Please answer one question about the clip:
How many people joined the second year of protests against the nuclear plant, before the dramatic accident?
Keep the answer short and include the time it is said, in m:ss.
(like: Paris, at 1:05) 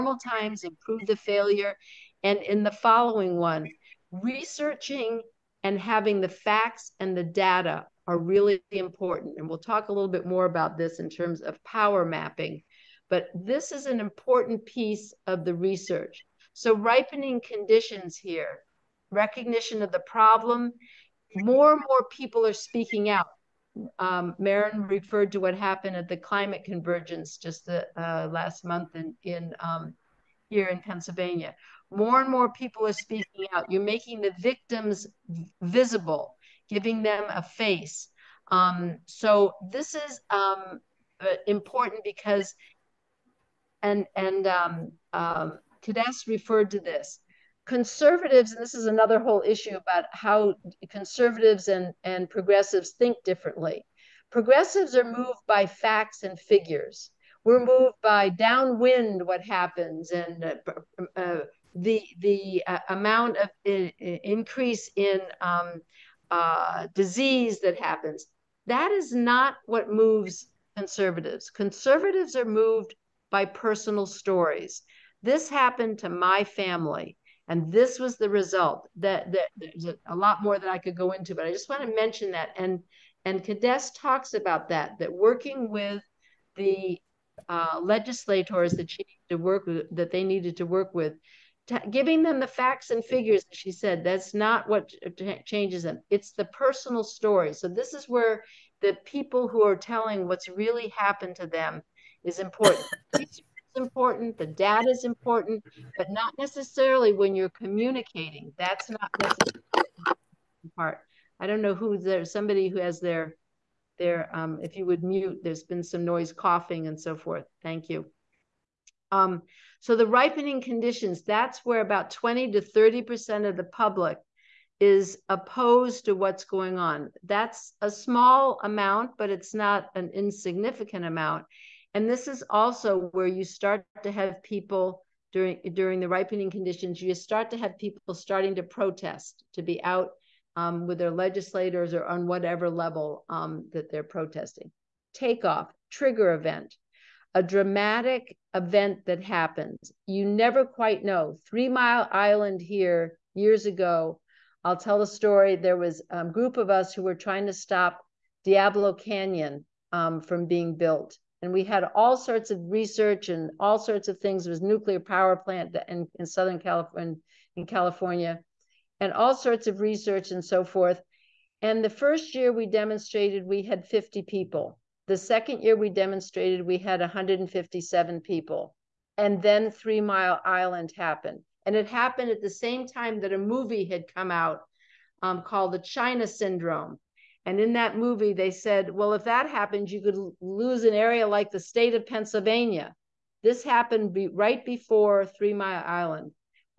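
157, at 2:57.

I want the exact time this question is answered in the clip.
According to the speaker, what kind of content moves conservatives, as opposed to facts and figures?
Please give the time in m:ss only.
1:13.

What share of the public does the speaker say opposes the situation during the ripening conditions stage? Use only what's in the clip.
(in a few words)
20 to 30%.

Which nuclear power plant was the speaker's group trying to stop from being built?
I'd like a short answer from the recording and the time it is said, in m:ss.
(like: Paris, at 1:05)
Diablo Canyon, at 2:38.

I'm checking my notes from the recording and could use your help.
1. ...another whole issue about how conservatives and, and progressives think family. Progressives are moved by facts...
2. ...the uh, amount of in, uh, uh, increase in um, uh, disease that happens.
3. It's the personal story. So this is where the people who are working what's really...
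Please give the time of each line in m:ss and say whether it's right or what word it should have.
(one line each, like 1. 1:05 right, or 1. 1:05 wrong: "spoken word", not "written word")
1. 0:48 wrong: "differently", not "family"
2. 1:02 right
3. 1:36 wrong: "telling", not "working".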